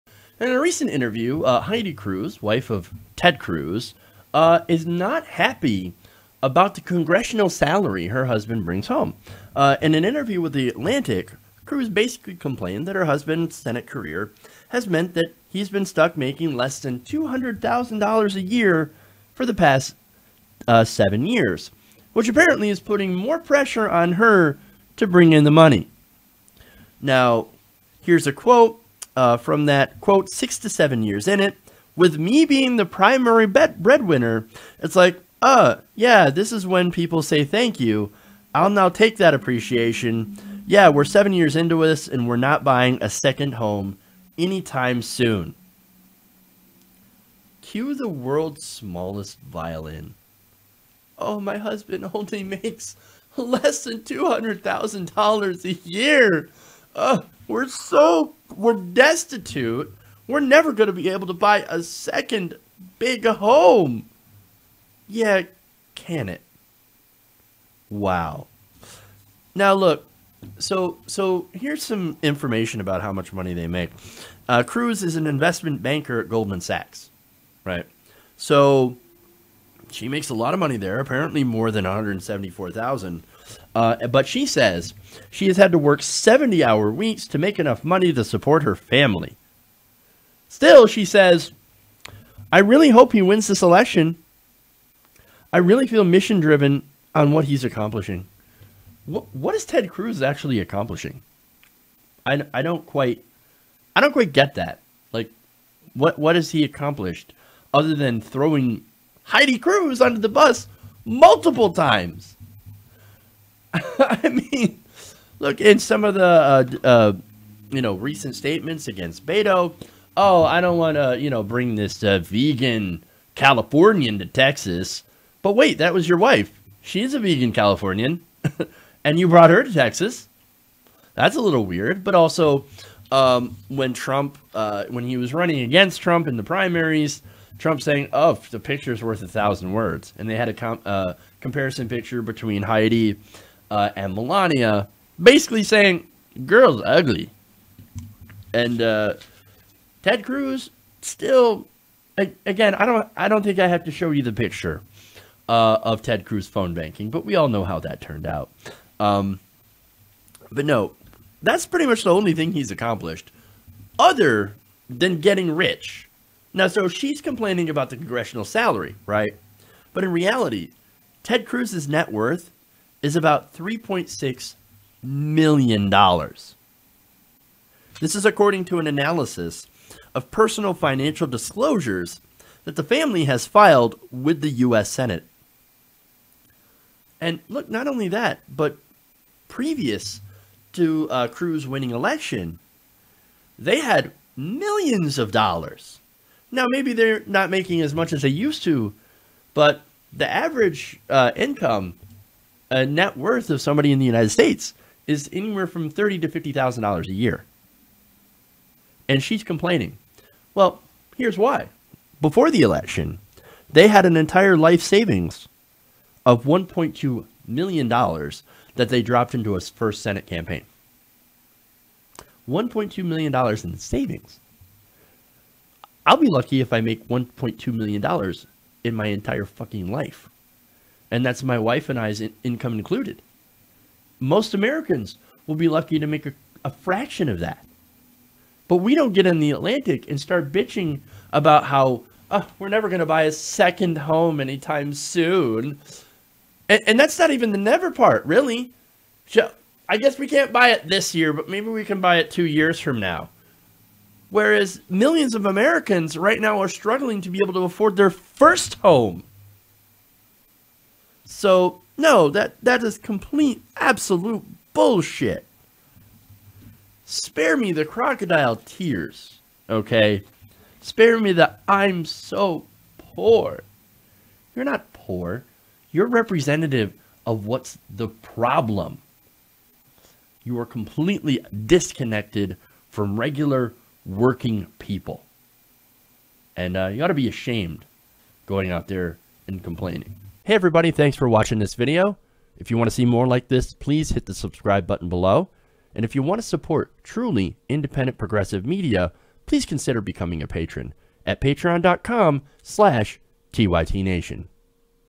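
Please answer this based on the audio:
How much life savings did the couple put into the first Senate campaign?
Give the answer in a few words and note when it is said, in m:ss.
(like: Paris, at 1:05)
$1.2 million, at 3:36.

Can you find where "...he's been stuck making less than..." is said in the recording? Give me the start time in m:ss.
0:15.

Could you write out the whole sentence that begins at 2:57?
This is according to an analysis of personal financial disclosures that the family has filed with the U.S.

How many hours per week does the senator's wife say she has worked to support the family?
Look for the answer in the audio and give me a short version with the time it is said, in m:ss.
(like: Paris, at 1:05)
70, at 1:26.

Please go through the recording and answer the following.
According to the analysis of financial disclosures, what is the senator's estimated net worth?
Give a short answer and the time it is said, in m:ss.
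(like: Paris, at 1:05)
$3.6 million, at 2:53.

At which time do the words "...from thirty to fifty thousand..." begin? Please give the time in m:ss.
3:25.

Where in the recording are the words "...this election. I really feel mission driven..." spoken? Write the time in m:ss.
1:33.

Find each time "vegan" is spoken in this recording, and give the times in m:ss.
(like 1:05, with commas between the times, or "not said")
2:02, 2:07.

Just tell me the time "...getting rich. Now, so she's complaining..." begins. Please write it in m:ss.
2:45.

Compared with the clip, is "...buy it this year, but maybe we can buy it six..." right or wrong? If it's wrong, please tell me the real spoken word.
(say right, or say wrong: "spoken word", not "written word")
wrong: "two", not "six".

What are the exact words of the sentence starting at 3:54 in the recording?
Most Americans will be lucky to make a, a fraction of that.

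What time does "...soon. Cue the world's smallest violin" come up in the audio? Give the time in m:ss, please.
0:45.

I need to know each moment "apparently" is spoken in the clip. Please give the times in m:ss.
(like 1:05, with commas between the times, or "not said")
0:22, 1:20.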